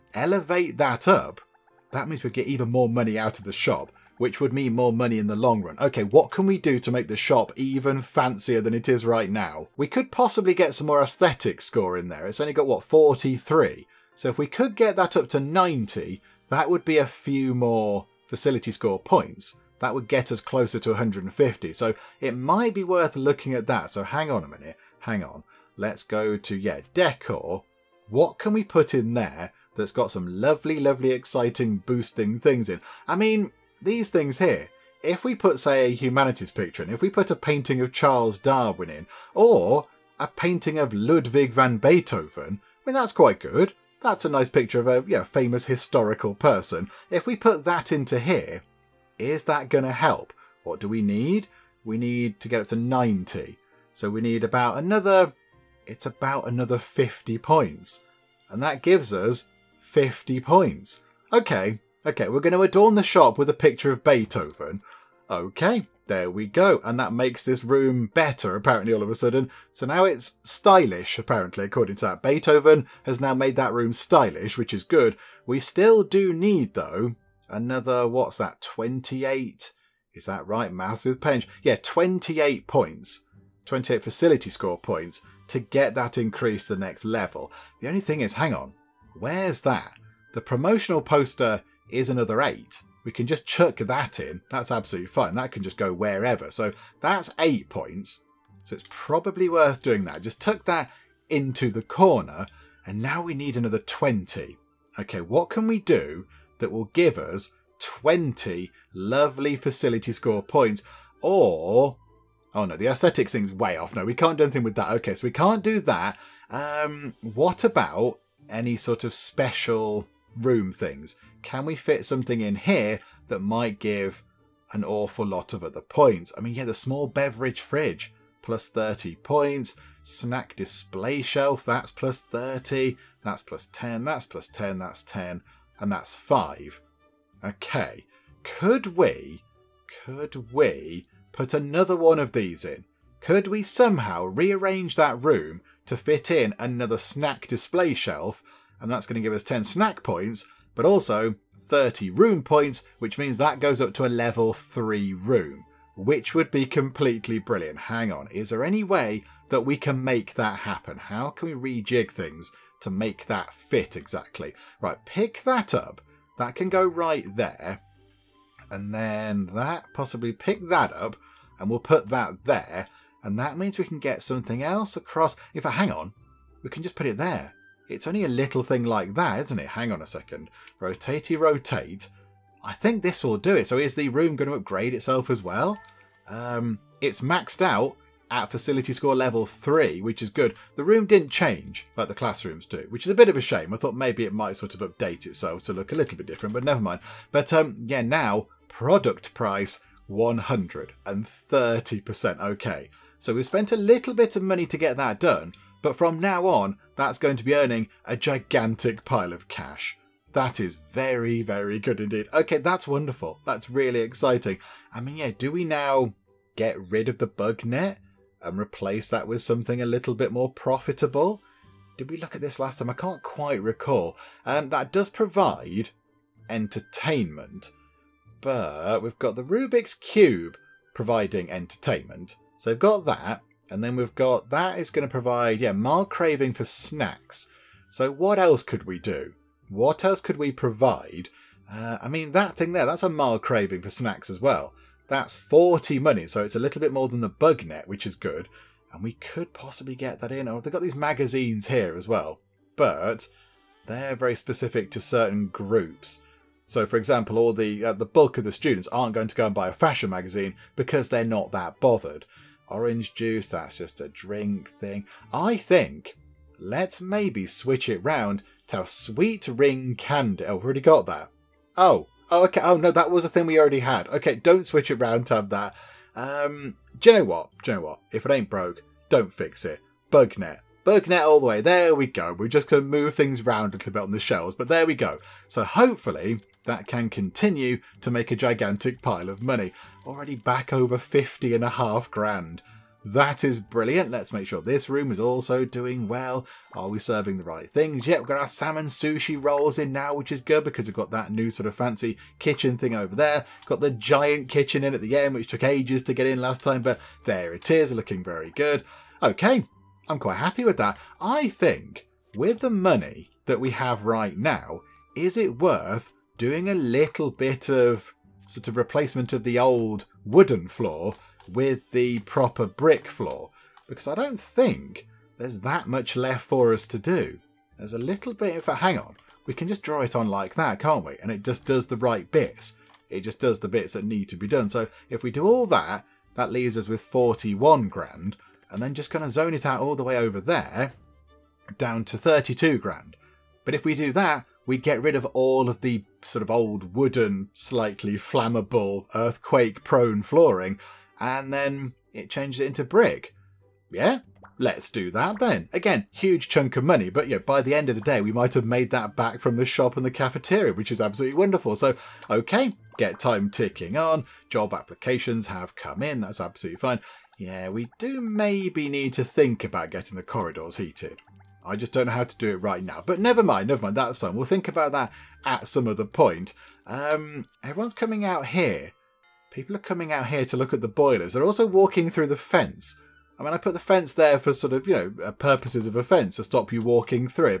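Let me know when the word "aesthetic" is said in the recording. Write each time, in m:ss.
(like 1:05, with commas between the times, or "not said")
0:11, 1:52.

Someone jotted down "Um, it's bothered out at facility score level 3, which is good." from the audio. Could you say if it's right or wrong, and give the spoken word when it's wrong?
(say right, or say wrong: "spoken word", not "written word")
wrong: "maxed", not "bothered".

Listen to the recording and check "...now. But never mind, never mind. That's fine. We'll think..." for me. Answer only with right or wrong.
right.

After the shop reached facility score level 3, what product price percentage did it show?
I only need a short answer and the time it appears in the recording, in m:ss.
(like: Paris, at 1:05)
130%, at 3:20.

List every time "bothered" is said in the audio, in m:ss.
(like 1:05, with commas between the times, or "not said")
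4:21.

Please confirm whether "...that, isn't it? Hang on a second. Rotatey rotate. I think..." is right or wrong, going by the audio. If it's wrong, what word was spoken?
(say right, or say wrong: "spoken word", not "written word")
right.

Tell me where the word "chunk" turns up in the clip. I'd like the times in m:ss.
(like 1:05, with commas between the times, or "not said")
5:56.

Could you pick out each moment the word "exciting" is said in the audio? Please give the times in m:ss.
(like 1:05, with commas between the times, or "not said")
0:31, 3:34.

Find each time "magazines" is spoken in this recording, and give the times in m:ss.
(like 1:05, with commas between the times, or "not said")
4:10, 4:20.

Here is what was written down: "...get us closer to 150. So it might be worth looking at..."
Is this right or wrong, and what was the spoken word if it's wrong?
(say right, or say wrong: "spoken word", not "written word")
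right.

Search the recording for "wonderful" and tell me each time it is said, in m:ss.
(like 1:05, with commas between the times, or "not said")
3:32, 6:01.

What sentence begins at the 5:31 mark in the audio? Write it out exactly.
And it just does the right bits.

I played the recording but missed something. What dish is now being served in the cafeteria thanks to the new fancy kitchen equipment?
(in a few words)
Salmon sushi rolls.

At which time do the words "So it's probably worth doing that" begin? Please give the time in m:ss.
1:38.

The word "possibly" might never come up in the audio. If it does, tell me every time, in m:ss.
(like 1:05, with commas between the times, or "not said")
0:10, 2:49, 4:09.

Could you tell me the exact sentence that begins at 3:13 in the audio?
I thought maybe it might sort of update itself to look a little bit different, but never mind.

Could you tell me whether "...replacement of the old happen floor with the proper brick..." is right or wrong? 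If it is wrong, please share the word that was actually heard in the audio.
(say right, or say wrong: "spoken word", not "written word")
wrong: "wooden", not "happen".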